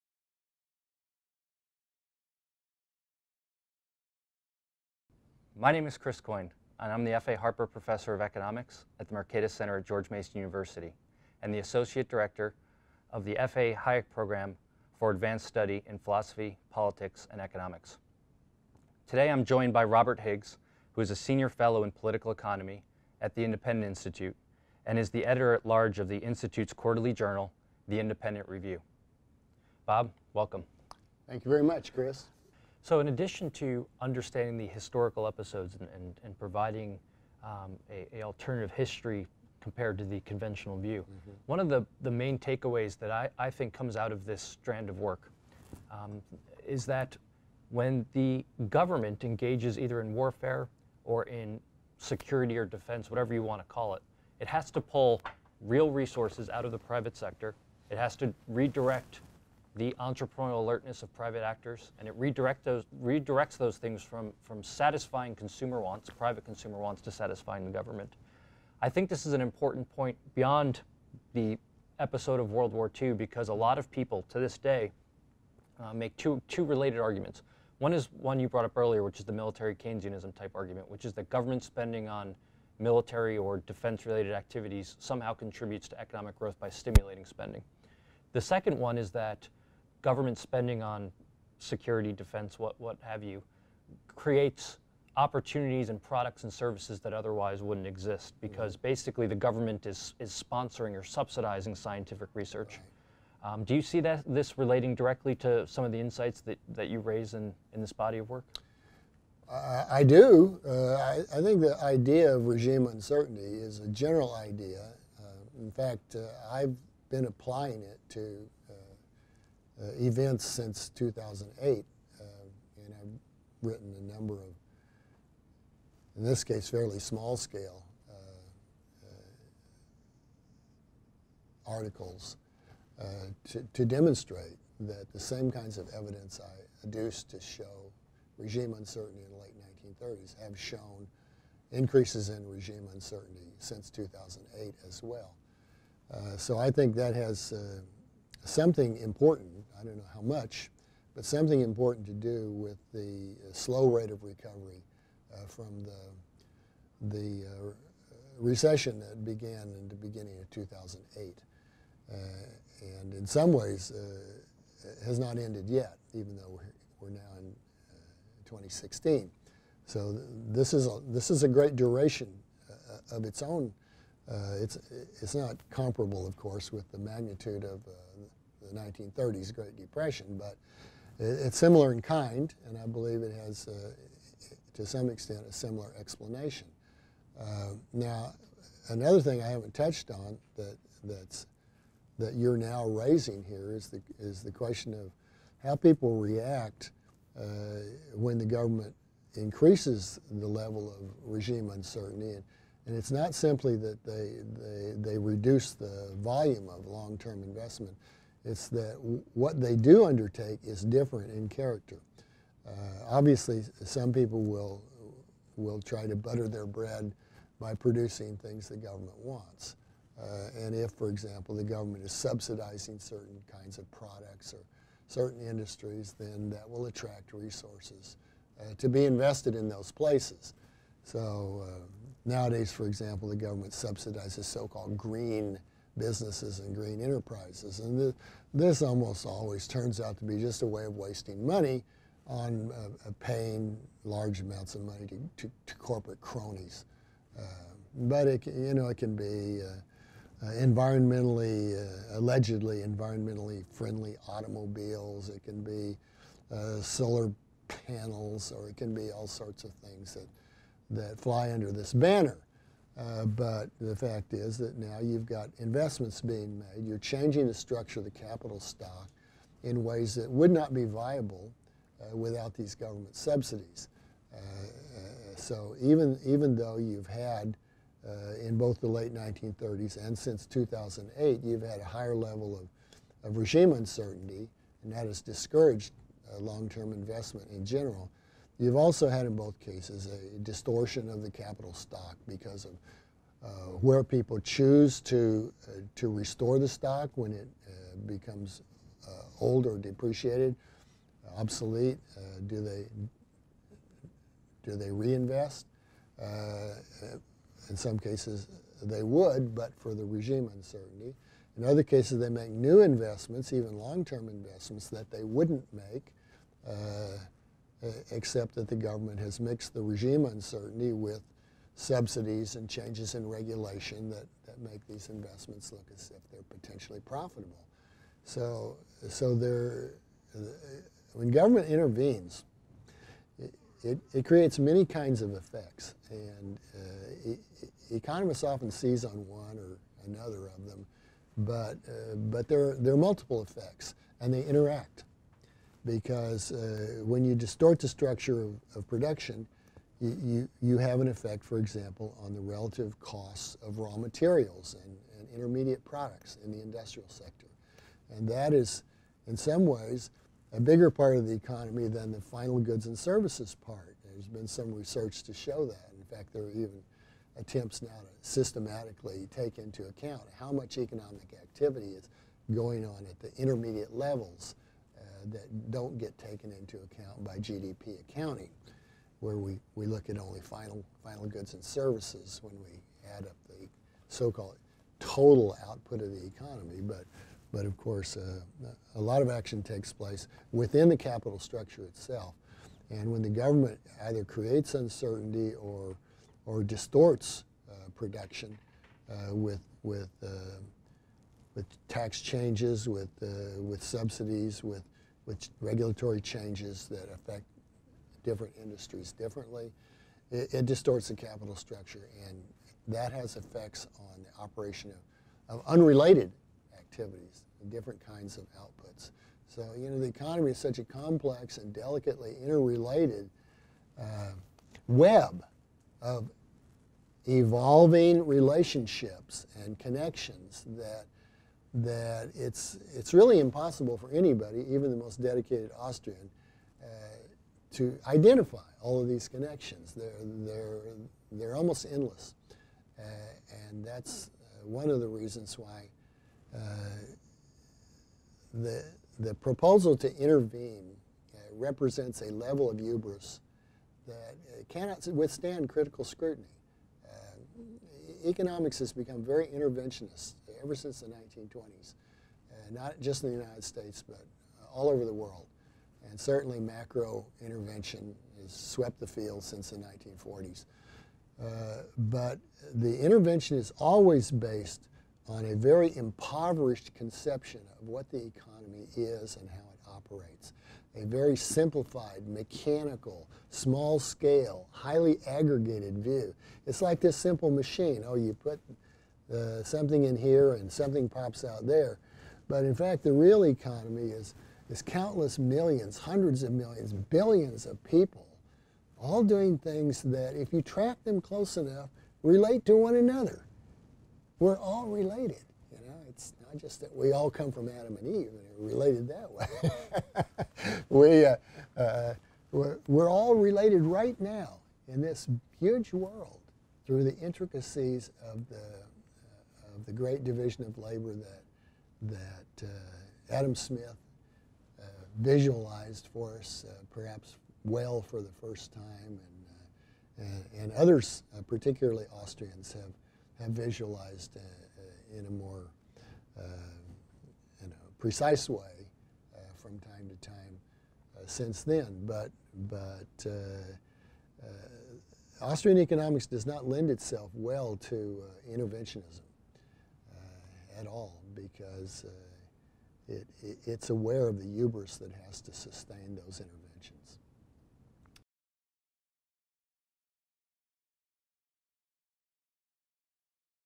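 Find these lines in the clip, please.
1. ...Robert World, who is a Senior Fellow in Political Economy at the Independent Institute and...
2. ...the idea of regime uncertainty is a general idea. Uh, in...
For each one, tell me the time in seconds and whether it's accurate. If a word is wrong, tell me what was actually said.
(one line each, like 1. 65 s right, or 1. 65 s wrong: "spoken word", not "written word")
1. 19 s wrong: "Higgs", not "World"
2. 111 s right.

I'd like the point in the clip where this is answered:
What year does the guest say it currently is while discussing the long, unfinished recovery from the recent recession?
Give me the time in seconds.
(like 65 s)
168 s.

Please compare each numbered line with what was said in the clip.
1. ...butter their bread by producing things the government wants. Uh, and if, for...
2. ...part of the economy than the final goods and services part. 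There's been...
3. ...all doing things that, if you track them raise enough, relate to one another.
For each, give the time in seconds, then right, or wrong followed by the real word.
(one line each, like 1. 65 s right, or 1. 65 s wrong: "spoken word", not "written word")
1. 216 s right
2. 360 s right
3. 498 s wrong: "close", not "raise".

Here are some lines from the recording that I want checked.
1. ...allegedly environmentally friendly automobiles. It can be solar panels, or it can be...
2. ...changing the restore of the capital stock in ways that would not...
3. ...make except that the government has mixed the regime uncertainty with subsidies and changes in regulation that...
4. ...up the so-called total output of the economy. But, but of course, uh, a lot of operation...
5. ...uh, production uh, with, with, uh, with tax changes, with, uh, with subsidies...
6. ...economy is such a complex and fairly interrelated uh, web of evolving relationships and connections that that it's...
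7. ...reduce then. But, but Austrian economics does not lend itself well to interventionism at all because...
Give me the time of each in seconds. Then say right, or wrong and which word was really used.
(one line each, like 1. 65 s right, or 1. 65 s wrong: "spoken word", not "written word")
1. 252 s right
2. 266 s wrong: "structure", not "restore"
3. 315 s right
4. 383 s wrong: "action", not "operation"
5. 397 s right
6. 420 s wrong: "delicately", not "fairly"
7. 541 s wrong: "since", not "reduce".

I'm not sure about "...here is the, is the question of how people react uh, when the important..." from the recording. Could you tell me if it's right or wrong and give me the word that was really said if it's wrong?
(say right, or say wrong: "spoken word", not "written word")
wrong: "government", not "important".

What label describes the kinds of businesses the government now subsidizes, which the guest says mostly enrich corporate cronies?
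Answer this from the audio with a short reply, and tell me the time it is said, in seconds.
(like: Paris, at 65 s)
green businesses, at 234 s.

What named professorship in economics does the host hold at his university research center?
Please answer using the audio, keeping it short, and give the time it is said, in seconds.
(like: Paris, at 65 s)
F.A. Harper Professor of Economics, at 7 s.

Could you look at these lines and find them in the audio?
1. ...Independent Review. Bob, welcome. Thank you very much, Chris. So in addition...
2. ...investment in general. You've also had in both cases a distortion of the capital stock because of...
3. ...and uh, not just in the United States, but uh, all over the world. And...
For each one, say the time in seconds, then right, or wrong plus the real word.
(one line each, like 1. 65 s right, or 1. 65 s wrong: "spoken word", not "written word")
1. 27 s right
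2. 286 s right
3. 462 s right.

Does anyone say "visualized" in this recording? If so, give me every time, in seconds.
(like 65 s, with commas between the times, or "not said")
525 s, 533 s.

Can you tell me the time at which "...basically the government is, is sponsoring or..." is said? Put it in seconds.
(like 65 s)
98 s.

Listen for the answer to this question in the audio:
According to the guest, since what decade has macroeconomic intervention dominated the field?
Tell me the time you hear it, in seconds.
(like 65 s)
469 s.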